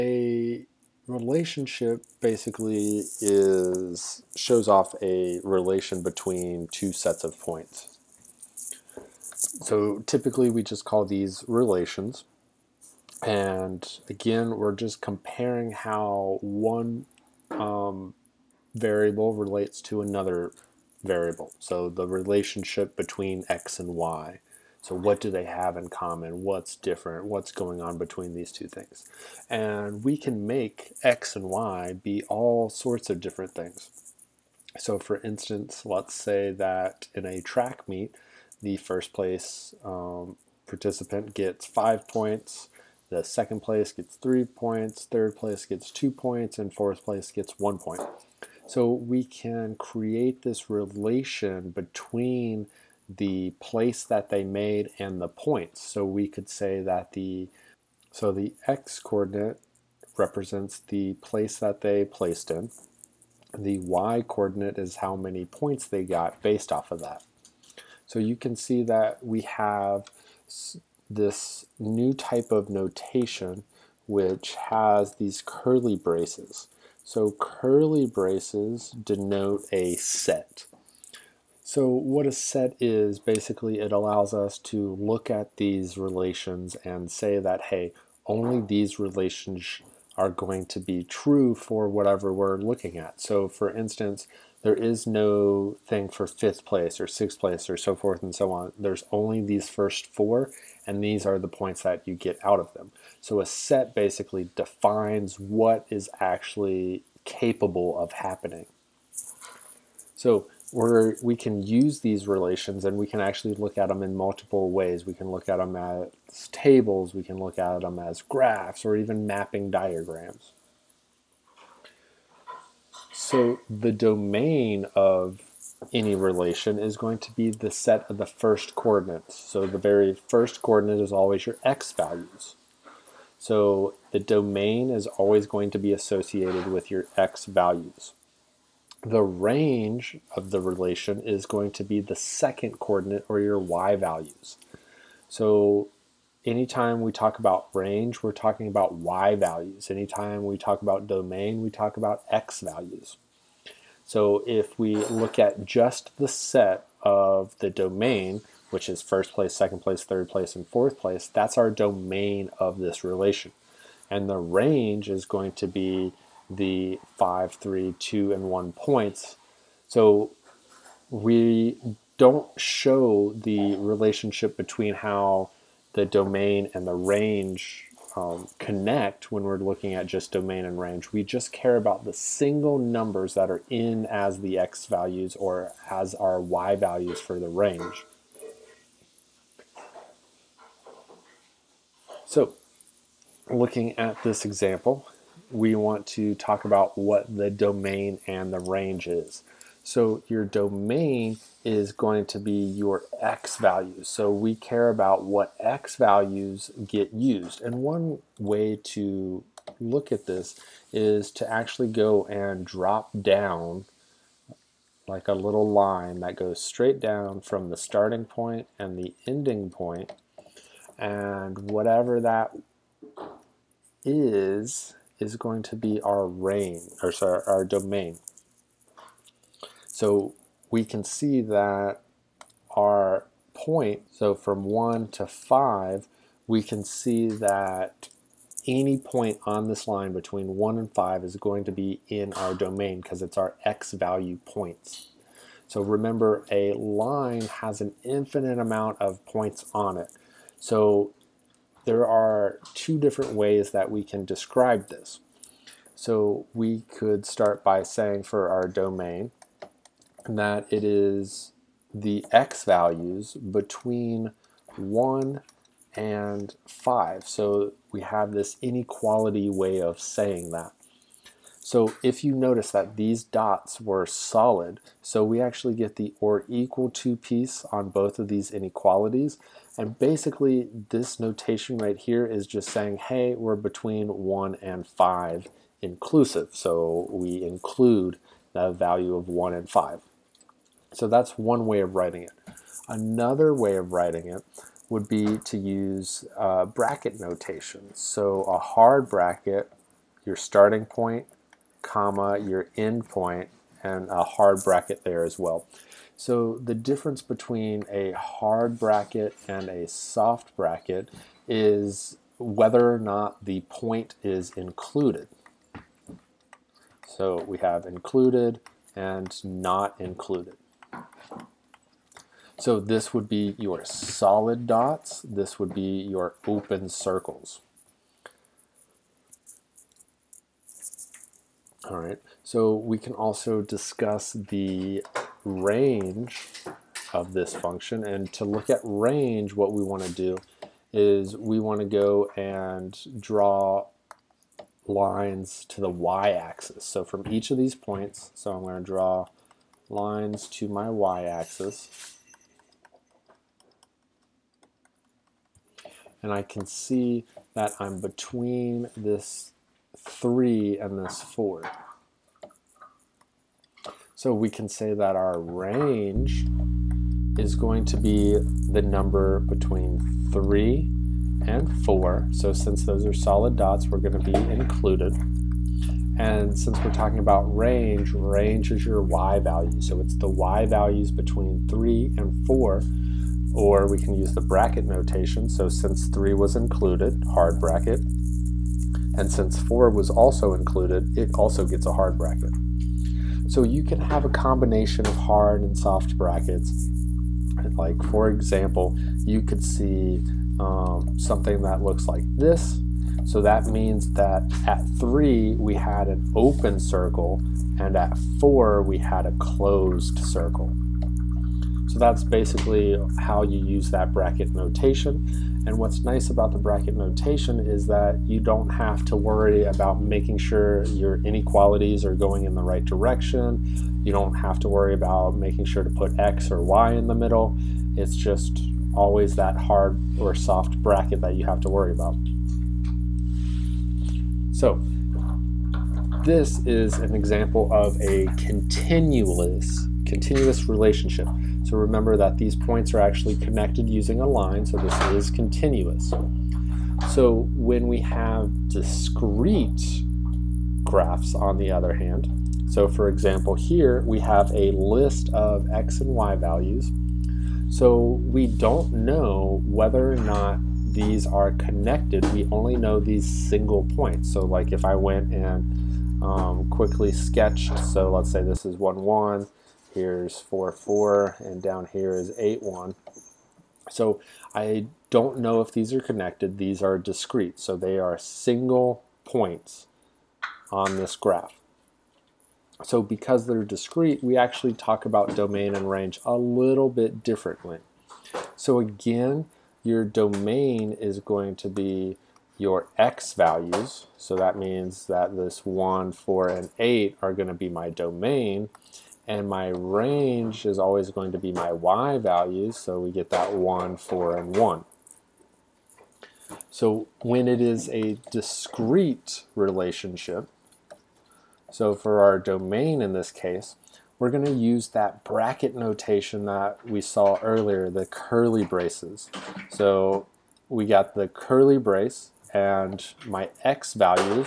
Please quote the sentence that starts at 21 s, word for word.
So the relationship between x and y.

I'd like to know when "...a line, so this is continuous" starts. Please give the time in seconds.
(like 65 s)
444 s.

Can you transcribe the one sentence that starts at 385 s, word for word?
So since 3 was included, hard bracket, and since 4 was also included, it also gets a hard bracket.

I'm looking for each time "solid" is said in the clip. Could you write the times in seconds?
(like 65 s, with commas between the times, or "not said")
274 s, 323 s, 373 s.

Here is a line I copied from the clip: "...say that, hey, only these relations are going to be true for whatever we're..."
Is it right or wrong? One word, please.
right.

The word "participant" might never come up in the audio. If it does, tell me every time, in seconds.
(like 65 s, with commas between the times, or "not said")
40 s.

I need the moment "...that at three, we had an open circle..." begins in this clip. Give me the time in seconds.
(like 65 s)
404 s.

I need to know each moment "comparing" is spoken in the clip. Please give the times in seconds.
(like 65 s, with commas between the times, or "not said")
15 s.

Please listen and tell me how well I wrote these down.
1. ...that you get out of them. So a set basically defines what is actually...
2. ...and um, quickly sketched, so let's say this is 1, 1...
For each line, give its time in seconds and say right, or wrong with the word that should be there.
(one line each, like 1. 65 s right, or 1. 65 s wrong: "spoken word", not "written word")
1. 101 s right
2. 465 s right.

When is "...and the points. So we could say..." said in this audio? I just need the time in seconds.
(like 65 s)
54 s.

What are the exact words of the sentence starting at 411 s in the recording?
So that's basically how you use that bracket notation.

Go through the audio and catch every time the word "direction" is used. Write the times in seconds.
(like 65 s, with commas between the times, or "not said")
422 s.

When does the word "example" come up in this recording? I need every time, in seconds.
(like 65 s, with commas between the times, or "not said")
194 s, 398 s, 437 s, 453 s.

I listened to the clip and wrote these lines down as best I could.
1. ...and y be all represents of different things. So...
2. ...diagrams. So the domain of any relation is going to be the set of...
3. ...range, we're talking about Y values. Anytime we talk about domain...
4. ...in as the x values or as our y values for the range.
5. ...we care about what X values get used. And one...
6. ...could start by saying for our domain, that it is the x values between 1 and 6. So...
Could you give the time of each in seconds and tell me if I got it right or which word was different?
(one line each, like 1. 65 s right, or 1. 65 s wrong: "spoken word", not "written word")
1. 31 s wrong: "sorts", not "represents"
2. 119 s right
3. 147 s right
4. 183 s right
5. 204 s right
6. 256 s wrong: "5", not "6".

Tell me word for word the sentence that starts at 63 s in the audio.
The y coordinate is how many points they got based off of that.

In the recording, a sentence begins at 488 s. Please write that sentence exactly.
So again, your domain is going to be your x values.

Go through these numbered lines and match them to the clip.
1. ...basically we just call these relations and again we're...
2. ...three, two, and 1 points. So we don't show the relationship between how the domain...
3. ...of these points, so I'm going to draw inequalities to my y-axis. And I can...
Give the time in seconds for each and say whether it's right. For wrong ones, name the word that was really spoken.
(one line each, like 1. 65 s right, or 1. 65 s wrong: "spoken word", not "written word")
1. 10 s wrong: "typically", not "basically"
2. 167 s right
3. 347 s wrong: "lines", not "inequalities".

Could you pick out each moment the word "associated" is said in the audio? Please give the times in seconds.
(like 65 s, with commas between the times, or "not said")
135 s.